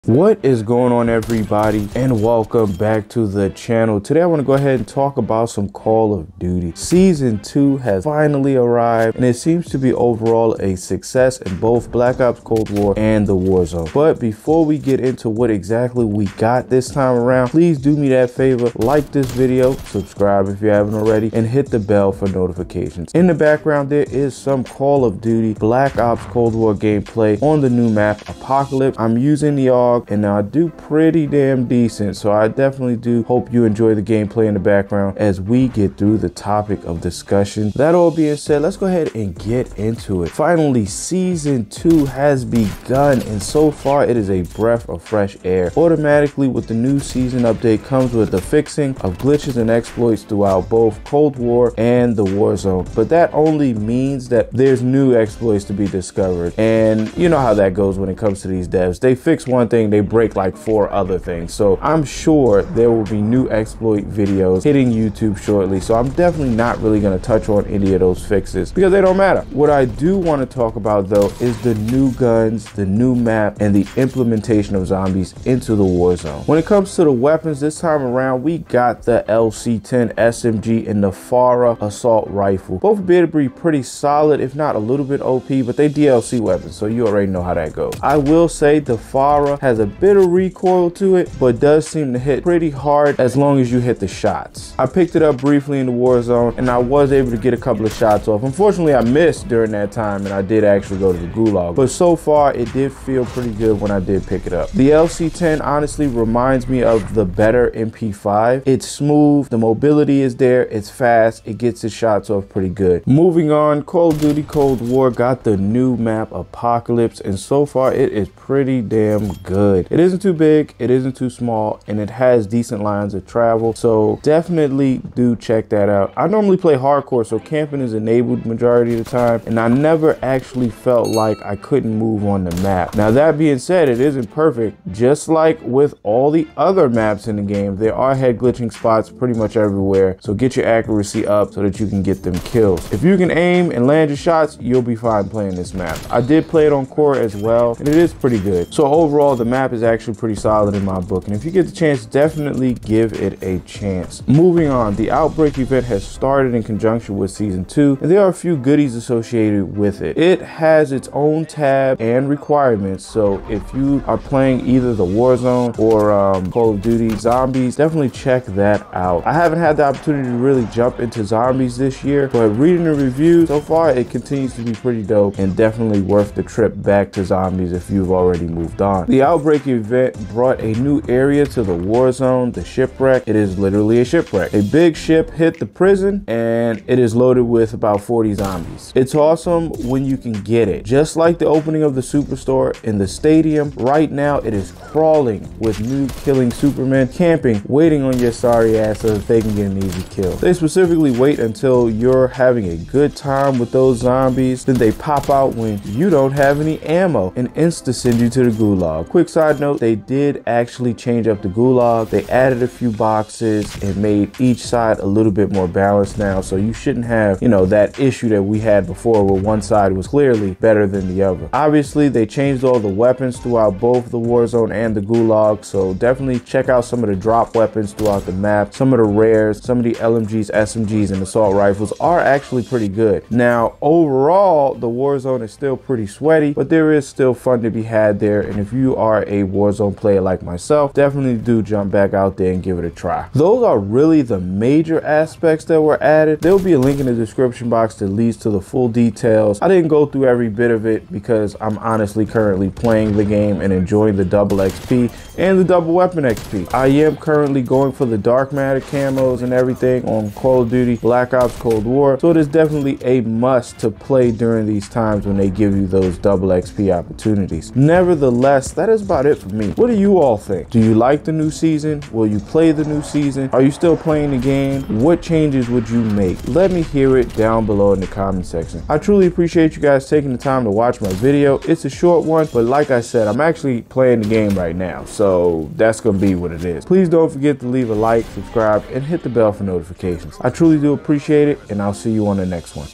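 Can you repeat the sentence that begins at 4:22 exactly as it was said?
So it is definitely a must to play during these times when they give you those double XP opportunities.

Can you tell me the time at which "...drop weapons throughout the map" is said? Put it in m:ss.
3:47.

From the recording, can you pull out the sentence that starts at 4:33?
Are you still playing the game?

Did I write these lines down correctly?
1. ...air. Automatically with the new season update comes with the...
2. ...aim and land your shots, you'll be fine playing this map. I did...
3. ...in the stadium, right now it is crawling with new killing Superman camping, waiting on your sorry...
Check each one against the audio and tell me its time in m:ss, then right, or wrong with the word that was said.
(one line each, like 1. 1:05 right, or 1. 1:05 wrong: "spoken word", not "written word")
1. 0:45 right
2. 2:23 right
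3. 3:12 right.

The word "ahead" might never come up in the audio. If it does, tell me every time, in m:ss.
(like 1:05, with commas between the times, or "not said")
0:04, 0:38.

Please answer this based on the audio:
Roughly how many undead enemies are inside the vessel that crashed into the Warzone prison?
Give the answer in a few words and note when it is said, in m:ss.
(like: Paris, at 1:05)
40, at 3:08.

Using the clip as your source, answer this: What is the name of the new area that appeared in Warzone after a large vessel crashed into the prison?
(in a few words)
the shipwreck.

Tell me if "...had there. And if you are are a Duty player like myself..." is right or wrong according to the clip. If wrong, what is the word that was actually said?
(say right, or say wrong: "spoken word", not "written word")
wrong: "Warzone", not "Duty".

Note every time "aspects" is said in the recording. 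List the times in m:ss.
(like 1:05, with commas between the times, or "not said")
4:05.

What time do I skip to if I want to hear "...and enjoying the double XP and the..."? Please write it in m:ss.
4:13.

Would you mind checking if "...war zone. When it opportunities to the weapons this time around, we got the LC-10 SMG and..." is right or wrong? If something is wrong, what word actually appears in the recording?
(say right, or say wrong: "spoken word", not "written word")
wrong: "comes", not "opportunities".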